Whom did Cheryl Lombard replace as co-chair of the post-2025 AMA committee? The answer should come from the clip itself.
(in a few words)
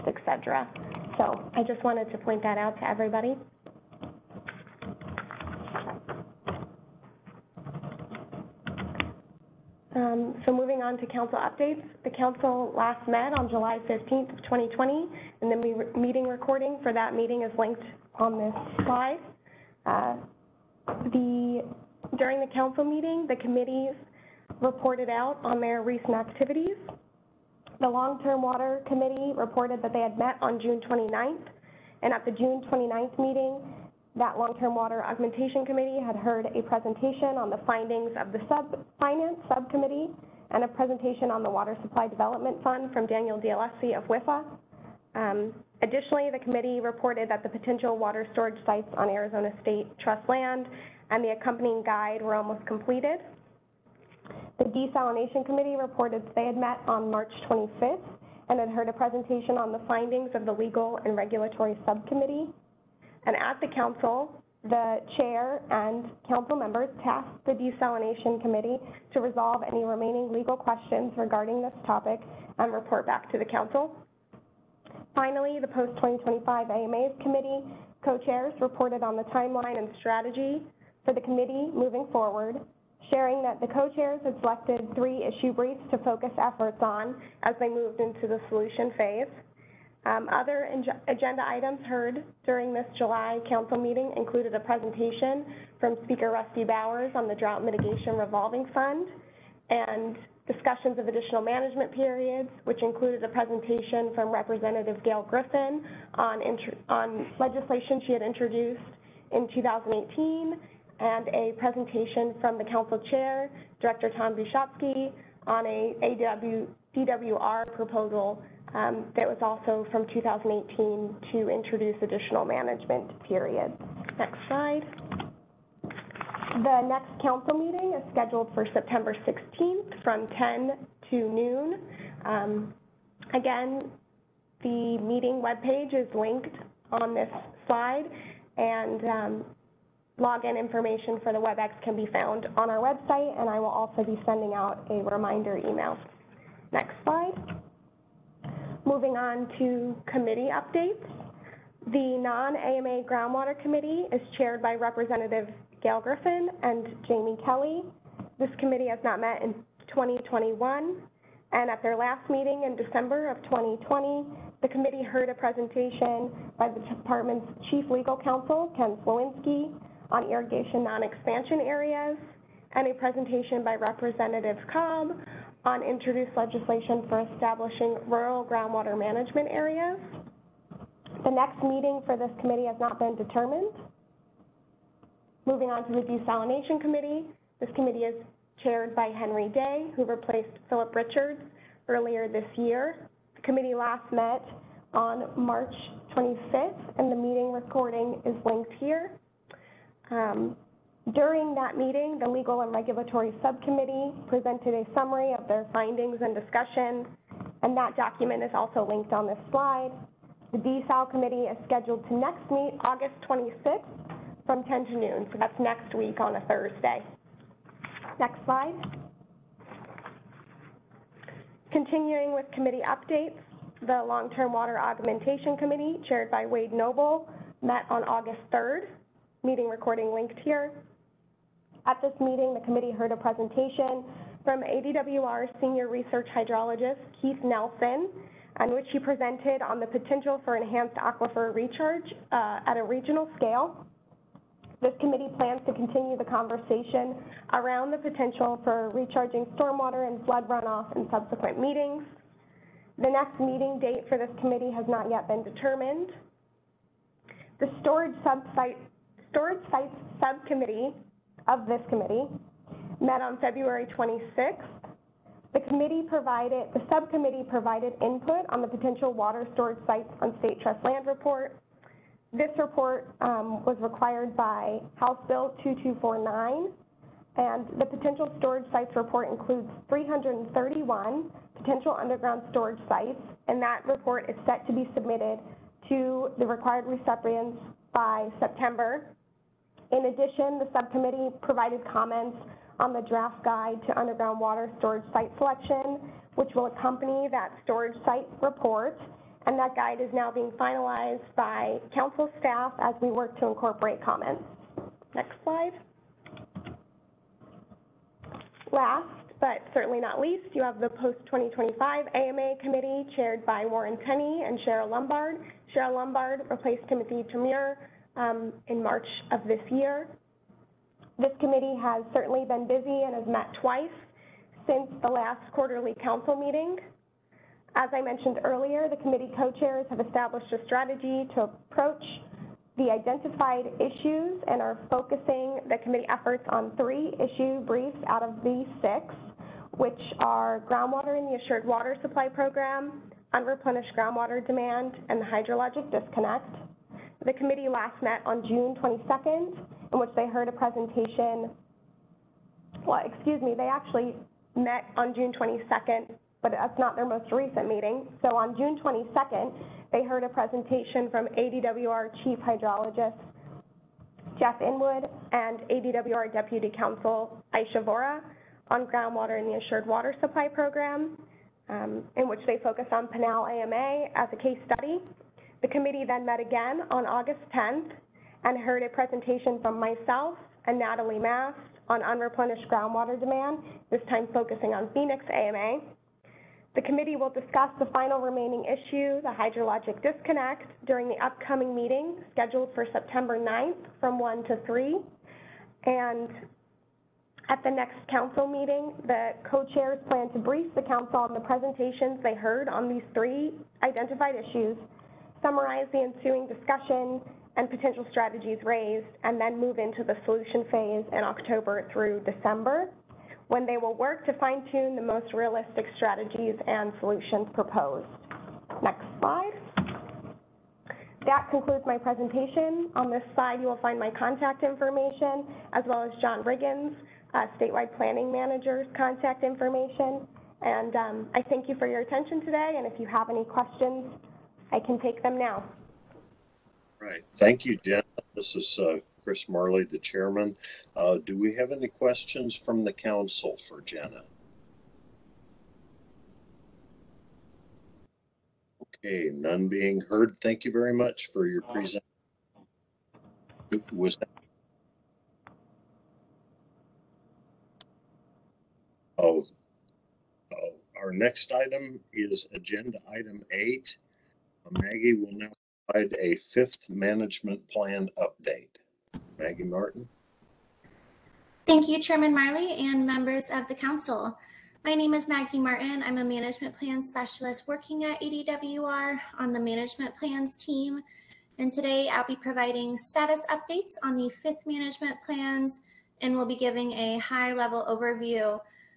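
Timothy Thomure.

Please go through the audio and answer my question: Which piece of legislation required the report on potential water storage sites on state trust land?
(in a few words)
House Bill 2249.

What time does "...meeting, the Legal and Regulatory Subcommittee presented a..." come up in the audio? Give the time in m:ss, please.
3:21.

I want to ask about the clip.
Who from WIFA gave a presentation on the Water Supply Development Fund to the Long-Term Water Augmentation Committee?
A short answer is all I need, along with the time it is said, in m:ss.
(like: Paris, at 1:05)
Daniel D'Alessi, at 0:43.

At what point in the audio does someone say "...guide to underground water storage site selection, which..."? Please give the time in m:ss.
4:53.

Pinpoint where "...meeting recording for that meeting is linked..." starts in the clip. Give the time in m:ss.
0:15.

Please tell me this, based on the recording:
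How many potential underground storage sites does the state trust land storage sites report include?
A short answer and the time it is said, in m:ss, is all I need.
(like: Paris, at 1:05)
331, at 4:39.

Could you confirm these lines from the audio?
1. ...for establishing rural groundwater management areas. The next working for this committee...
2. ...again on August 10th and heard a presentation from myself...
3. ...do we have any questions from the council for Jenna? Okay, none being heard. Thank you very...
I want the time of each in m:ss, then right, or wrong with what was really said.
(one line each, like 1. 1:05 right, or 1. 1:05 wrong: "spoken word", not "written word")
1. 2:57 wrong: "meeting", not "working"
2. 6:16 right
3. 7:21 right.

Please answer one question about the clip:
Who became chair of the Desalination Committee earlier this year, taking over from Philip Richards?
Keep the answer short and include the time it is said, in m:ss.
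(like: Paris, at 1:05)
Henry Day, at 3:09.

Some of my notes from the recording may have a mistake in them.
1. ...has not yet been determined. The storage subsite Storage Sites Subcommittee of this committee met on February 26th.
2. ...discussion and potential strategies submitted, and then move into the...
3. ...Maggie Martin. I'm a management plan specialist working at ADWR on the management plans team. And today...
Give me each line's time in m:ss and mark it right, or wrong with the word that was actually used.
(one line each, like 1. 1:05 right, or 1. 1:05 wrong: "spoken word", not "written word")
1. 4:14 right
2. 6:46 wrong: "raised", not "submitted"
3. 7:55 right.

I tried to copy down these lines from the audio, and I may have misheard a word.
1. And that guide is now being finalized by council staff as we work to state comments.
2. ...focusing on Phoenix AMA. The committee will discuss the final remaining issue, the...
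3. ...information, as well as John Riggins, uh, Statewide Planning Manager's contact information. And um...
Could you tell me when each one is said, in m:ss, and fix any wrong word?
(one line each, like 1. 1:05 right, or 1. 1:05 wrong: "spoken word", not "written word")
1. 4:59 wrong: "incorporate", not "state"
2. 6:24 right
3. 7:04 right.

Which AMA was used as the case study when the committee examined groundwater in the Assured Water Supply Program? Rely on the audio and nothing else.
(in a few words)
Pinal AMA.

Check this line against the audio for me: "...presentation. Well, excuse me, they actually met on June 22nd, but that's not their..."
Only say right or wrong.
right.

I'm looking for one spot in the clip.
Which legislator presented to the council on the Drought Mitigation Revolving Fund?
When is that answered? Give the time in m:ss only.
1:36.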